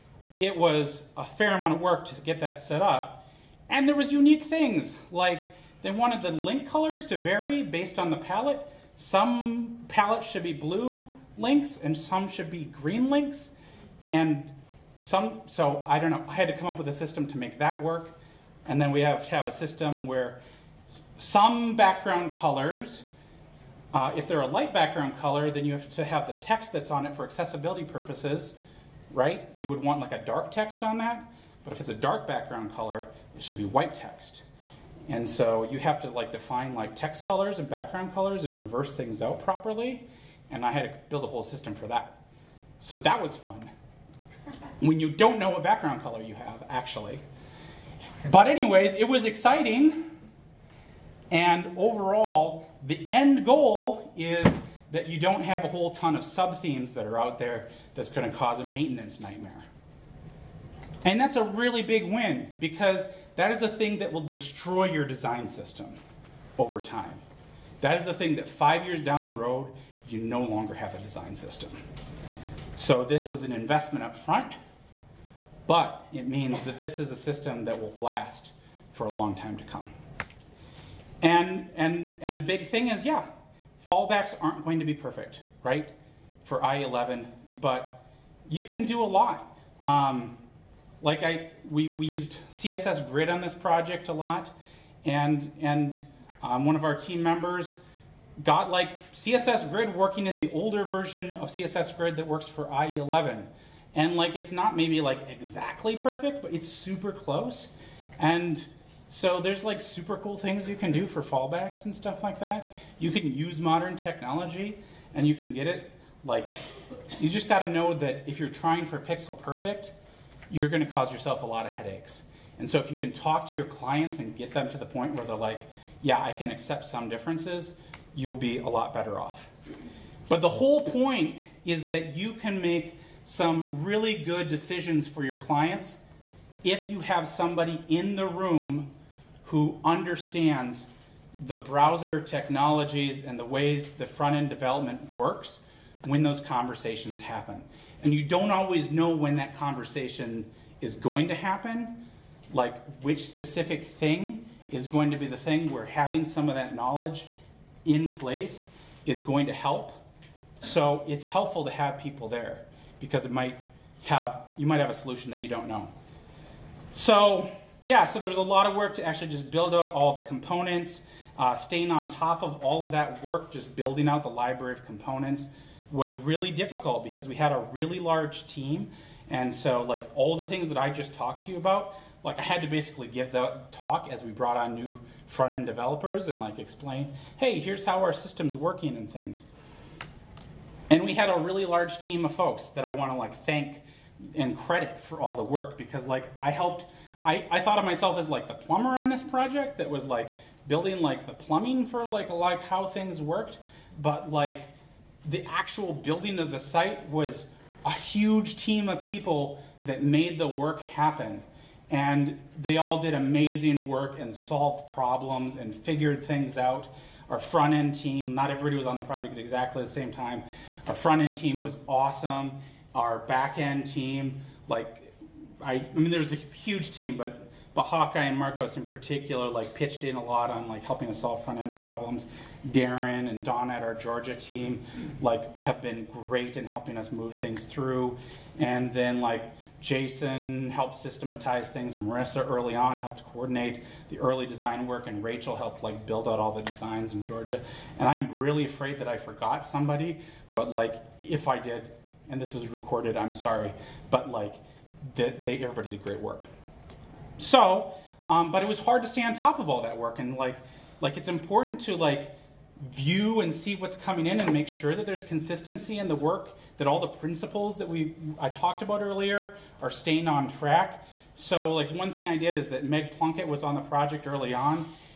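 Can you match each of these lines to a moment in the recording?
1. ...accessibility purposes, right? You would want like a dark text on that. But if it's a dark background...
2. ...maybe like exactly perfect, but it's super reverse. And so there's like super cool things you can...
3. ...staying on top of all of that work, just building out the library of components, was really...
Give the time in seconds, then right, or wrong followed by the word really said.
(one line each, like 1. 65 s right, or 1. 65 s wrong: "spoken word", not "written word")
1. 27 s right
2. 104 s wrong: "close", not "reverse"
3. 171 s right.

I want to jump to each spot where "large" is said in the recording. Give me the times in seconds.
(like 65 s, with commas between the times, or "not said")
177 s, 191 s.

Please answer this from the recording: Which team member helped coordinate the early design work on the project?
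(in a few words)
Marissa.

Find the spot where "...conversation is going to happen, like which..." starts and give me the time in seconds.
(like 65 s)
149 s.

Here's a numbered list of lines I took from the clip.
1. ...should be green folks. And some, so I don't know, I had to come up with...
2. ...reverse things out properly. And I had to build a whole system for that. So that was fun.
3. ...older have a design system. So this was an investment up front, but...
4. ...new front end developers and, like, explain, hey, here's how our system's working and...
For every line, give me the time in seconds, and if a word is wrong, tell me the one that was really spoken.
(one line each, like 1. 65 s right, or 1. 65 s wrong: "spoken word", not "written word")
1. 12 s wrong: "links", not "folks"
2. 38 s right
3. 70 s wrong: "longer", not "older"
4. 184 s right.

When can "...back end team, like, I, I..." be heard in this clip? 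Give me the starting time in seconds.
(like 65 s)
223 s.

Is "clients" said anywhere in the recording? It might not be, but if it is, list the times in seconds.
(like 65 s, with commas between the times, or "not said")
123 s, 135 s.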